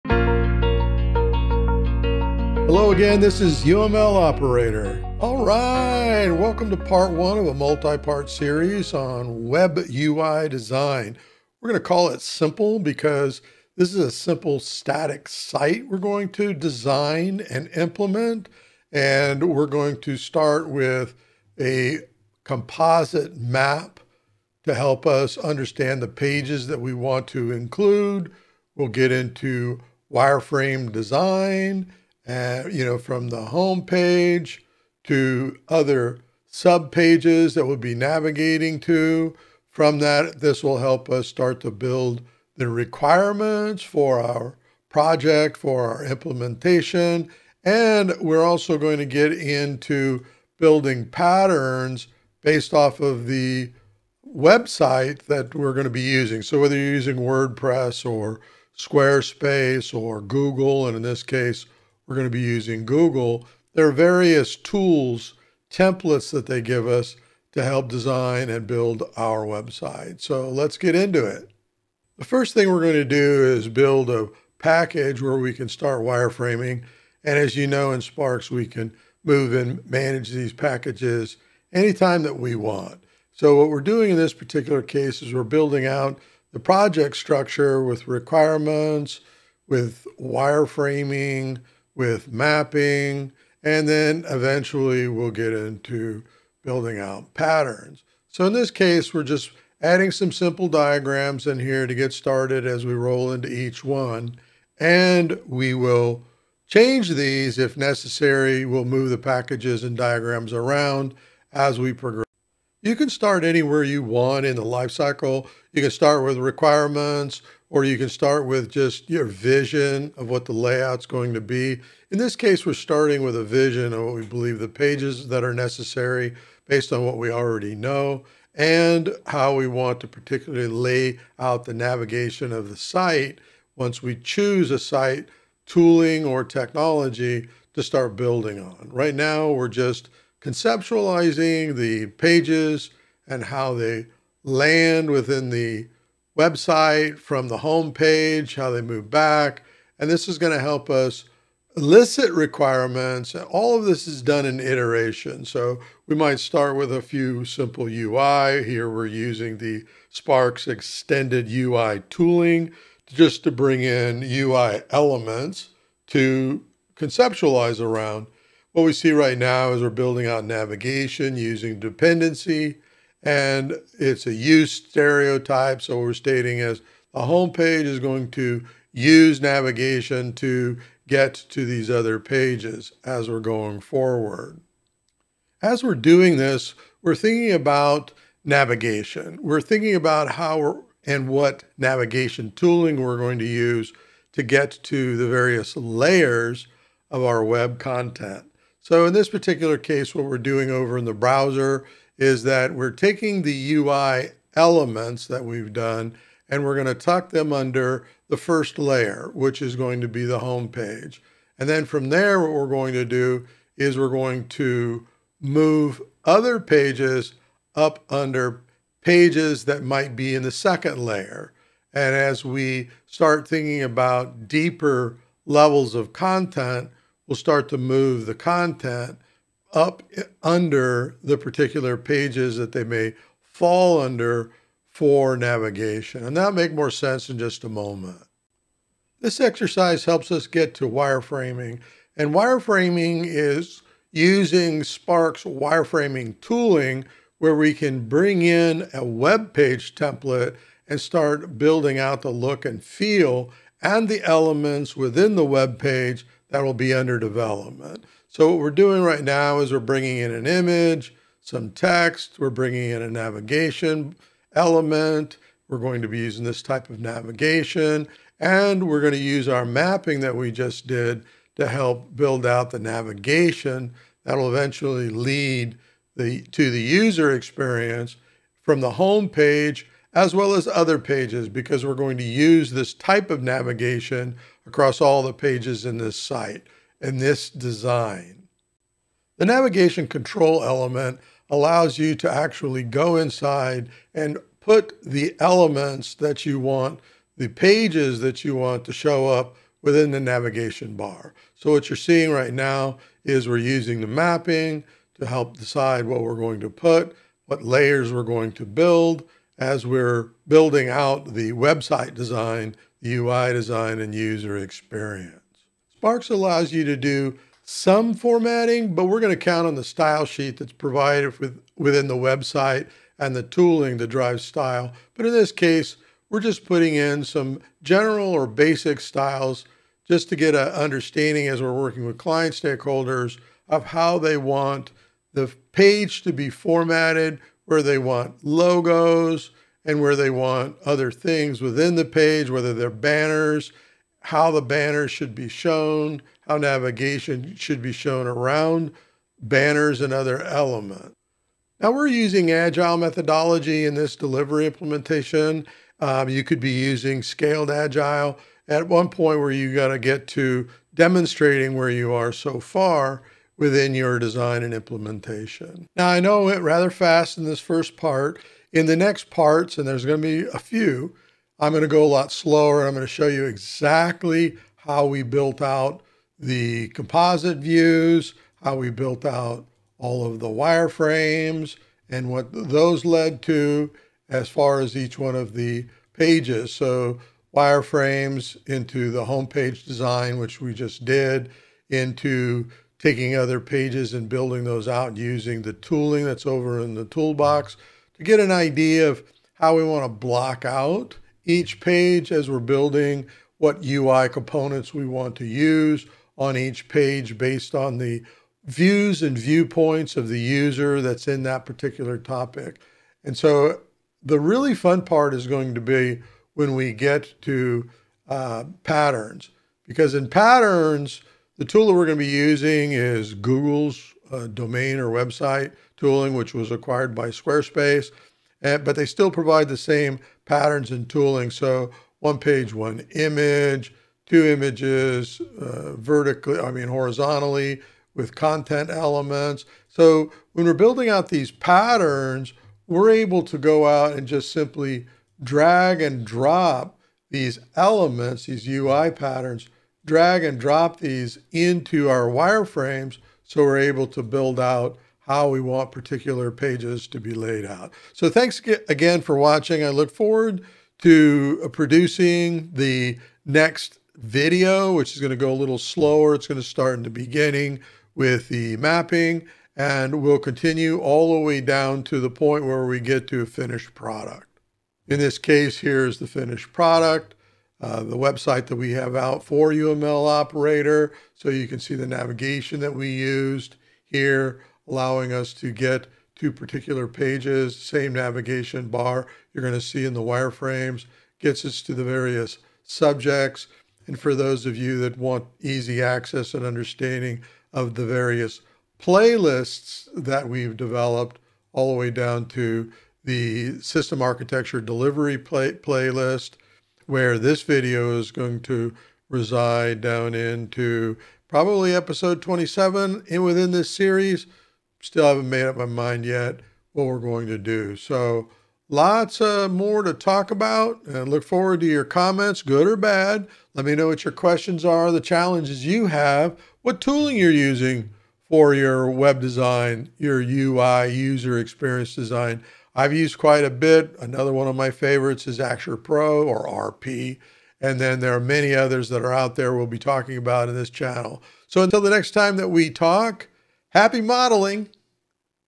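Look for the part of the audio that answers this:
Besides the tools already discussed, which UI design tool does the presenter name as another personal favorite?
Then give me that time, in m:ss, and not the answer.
8:55.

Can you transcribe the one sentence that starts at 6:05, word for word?
Now I know it rather fast in this first part.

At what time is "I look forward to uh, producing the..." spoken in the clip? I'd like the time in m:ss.
7:39.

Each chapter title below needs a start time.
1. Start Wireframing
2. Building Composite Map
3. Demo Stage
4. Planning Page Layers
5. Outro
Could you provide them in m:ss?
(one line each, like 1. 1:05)
1. 4:01
2. 1:51
3. 5:54
4. 3:14
5. 7:54.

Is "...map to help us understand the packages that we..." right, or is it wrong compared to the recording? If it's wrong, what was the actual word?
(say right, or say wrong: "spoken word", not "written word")
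wrong: "pages", not "packages".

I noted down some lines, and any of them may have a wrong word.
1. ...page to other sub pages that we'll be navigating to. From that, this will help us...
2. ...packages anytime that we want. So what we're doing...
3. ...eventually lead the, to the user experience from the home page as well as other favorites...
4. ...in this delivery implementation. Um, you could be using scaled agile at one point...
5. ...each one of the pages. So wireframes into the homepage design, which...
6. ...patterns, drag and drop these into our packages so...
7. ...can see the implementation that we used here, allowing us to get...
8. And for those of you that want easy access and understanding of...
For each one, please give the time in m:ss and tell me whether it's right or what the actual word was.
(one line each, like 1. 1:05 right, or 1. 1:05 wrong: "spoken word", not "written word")
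1. 0:33 right
2. 1:20 right
3. 4:34 wrong: "pages", not "favorites"
4. 5:53 right
5. 6:24 right
6. 7:29 wrong: "wireframes", not "packages"
7. 8:01 wrong: "navigation", not "implementation"
8. 8:14 right.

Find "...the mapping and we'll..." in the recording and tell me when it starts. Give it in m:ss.
7:48.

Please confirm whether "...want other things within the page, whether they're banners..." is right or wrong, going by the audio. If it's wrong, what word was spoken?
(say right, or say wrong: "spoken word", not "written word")
right.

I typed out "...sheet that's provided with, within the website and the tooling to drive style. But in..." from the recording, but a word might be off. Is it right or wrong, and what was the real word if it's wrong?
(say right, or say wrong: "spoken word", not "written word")
right.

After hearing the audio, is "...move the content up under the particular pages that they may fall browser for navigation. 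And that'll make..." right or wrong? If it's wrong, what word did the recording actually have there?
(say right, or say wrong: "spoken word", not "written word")
wrong: "under", not "browser".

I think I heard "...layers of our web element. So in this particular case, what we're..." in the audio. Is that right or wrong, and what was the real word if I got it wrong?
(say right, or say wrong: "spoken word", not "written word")
wrong: "content", not "element".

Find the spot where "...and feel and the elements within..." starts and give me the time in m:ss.
4:12.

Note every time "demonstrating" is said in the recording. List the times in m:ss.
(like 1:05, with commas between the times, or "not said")
6:00.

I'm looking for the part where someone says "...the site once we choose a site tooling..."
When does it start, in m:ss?
2:12.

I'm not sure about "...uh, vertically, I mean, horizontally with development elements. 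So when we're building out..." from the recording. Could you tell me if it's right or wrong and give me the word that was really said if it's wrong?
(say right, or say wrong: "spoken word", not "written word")
wrong: "content", not "development".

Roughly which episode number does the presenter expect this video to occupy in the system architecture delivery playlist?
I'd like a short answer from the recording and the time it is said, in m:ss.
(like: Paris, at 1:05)
27, at 8:31.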